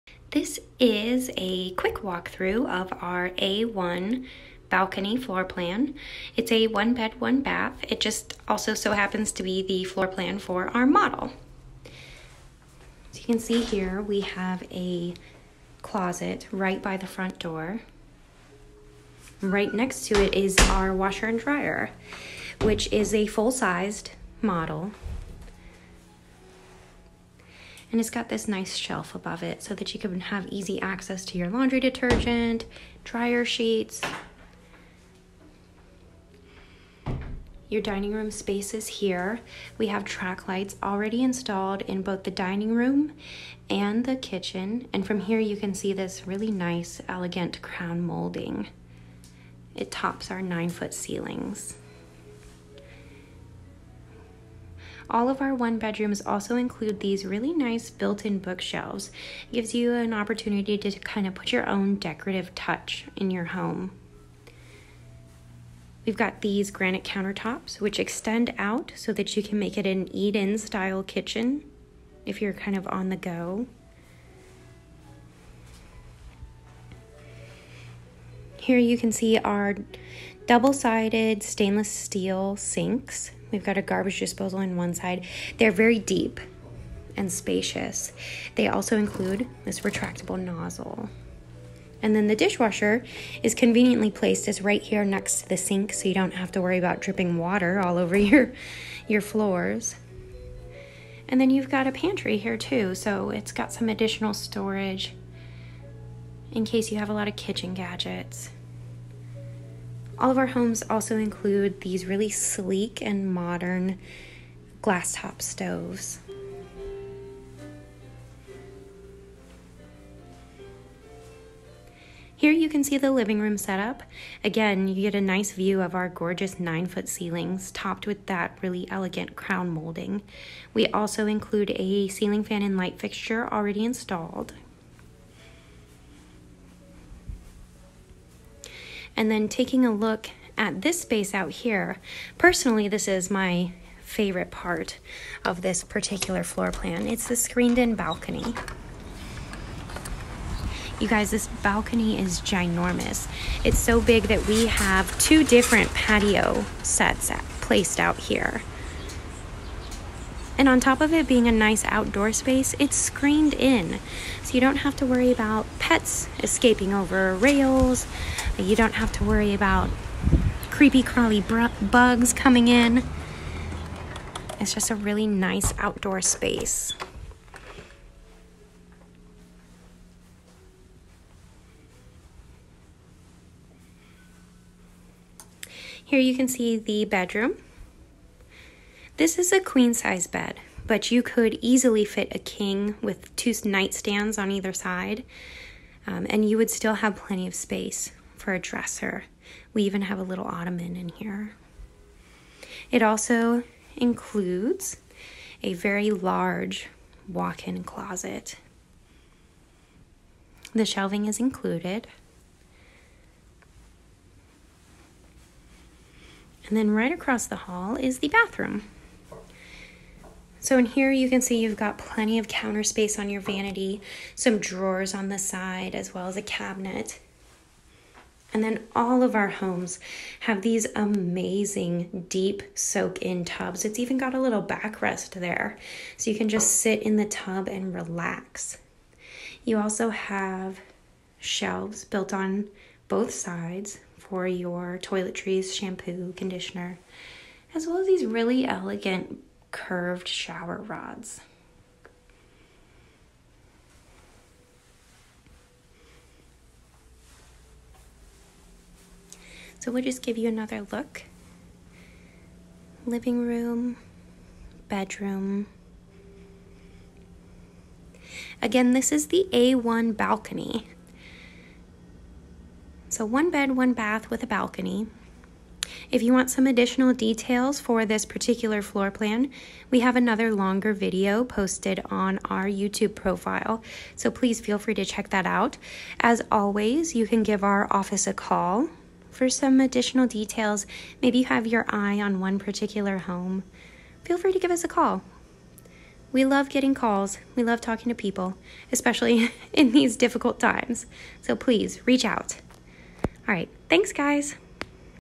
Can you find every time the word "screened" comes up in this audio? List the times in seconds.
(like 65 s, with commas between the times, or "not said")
147 s, 162 s.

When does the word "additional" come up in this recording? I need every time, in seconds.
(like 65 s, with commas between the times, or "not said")
103 s, 276 s, 289 s.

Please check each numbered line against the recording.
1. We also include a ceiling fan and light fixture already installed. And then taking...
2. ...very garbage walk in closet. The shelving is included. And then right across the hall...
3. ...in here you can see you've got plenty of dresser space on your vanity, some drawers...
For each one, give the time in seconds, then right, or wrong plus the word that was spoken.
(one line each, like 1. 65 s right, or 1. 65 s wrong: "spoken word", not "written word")
1. 130 s right
2. 205 s wrong: "large", not "garbage"
3. 220 s wrong: "counter", not "dresser".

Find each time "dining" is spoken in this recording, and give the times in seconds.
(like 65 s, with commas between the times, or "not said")
37 s, 42 s.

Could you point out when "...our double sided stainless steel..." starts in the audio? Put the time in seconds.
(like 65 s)
79 s.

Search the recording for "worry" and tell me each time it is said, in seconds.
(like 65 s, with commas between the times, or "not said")
96 s, 165 s, 169 s.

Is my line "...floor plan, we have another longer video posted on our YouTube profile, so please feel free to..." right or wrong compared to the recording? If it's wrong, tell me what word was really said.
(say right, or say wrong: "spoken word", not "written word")
right.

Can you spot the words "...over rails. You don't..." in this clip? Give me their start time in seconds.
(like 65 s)
166 s.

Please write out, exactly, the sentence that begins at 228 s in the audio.
And then all of our homes have these amazing deep soak in tubs.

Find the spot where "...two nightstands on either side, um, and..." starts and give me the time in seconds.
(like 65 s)
193 s.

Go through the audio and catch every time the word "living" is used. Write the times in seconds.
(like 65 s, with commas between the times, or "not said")
123 s, 263 s.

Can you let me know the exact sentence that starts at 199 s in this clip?
We even have a little ottoman in here.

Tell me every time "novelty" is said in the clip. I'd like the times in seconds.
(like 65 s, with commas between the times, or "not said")
not said.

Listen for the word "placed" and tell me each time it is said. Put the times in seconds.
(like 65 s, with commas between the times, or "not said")
94 s, 157 s.